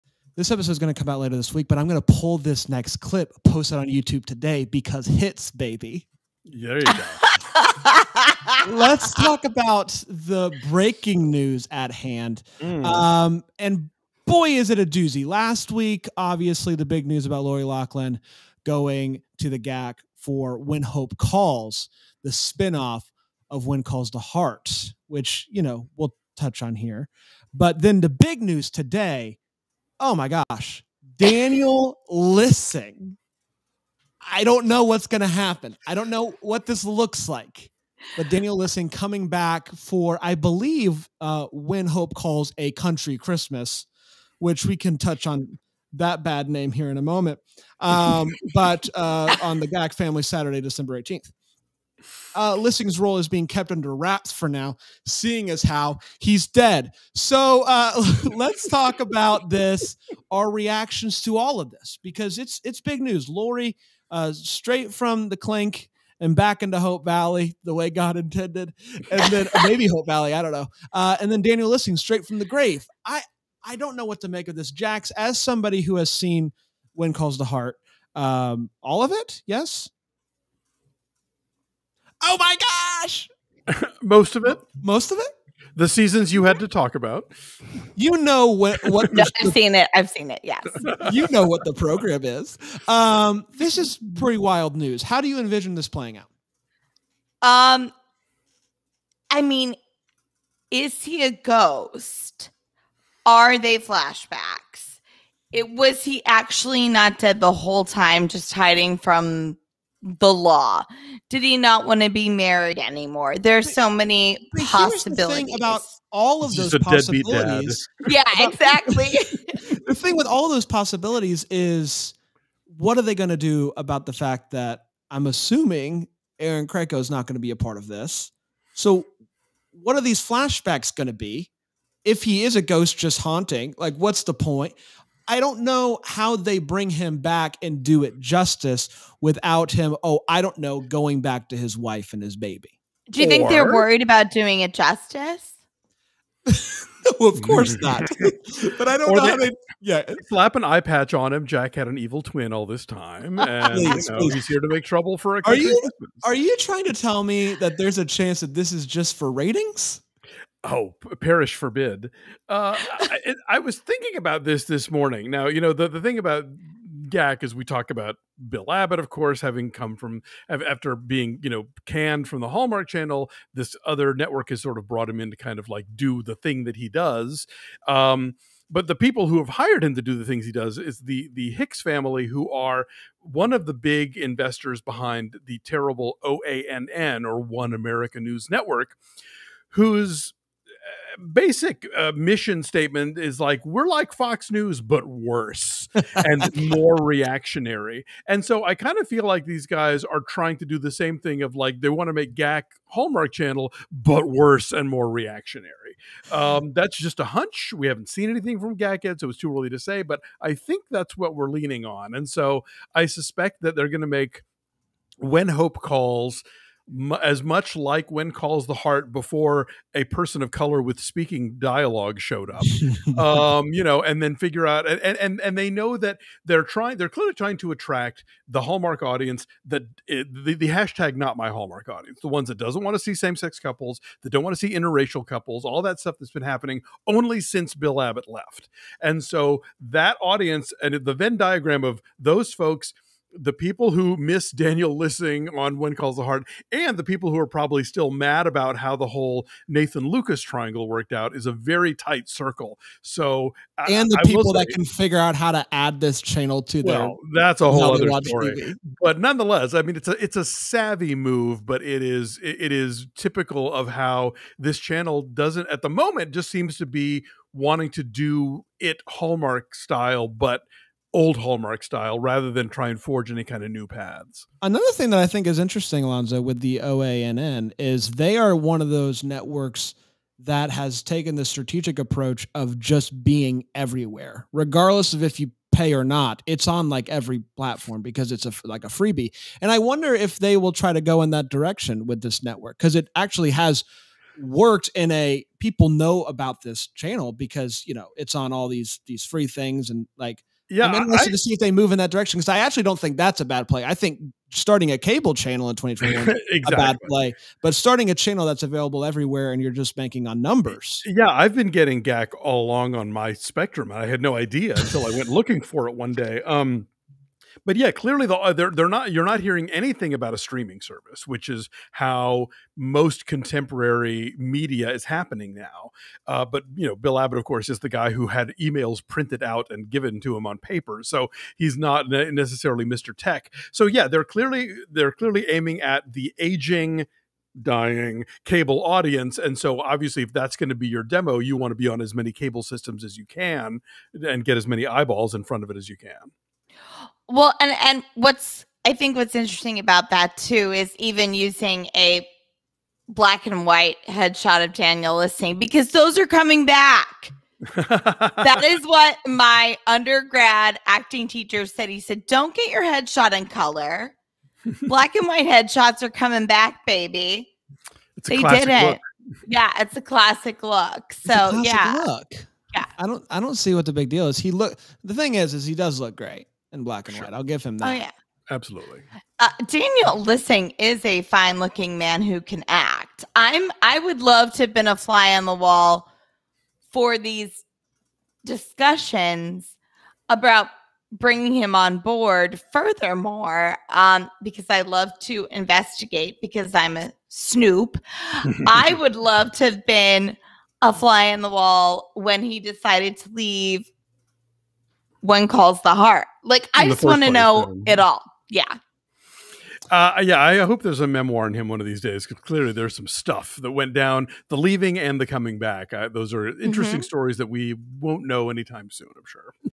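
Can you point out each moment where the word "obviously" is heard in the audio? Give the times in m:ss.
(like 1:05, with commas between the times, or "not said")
0:16, 5:39.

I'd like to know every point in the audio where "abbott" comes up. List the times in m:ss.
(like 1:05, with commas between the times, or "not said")
2:48, 3:58, 5:27.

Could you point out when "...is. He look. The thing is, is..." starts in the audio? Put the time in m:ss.
6:14.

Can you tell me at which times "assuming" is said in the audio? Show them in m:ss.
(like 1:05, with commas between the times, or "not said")
2:05.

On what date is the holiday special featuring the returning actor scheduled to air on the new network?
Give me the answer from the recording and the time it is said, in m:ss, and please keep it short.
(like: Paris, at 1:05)
Saturday, December 18th, at 0:50.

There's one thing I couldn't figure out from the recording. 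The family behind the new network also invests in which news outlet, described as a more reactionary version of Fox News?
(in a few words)
One America News Network.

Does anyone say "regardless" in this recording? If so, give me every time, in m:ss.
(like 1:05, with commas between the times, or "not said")
4:44.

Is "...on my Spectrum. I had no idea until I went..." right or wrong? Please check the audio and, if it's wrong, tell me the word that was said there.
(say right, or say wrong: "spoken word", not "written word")
right.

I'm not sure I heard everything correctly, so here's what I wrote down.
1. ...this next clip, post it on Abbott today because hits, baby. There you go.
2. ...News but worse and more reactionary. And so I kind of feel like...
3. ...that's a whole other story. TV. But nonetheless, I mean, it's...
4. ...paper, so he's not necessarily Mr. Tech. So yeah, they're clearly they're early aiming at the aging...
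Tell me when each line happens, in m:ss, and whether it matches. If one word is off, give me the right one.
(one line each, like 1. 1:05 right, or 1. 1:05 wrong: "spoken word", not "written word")
1. 0:02 wrong: "YouTube", not "Abbott"
2. 3:14 right
3. 4:17 right
4. 5:30 wrong: "clearly", not "early".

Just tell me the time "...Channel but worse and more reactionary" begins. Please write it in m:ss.
3:23.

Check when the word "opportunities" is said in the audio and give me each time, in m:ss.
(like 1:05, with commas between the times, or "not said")
not said.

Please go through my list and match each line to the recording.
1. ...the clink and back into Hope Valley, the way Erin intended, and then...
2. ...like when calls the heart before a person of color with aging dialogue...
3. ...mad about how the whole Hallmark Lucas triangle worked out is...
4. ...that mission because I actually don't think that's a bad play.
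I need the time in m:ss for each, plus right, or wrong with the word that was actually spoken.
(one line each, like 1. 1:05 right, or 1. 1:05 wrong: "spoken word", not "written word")
1. 1:05 wrong: "God", not "Erin"
2. 3:37 wrong: "speaking", not "aging"
3. 4:08 wrong: "Nathan", not "Hallmark"
4. 5:01 wrong: "direction", not "mission".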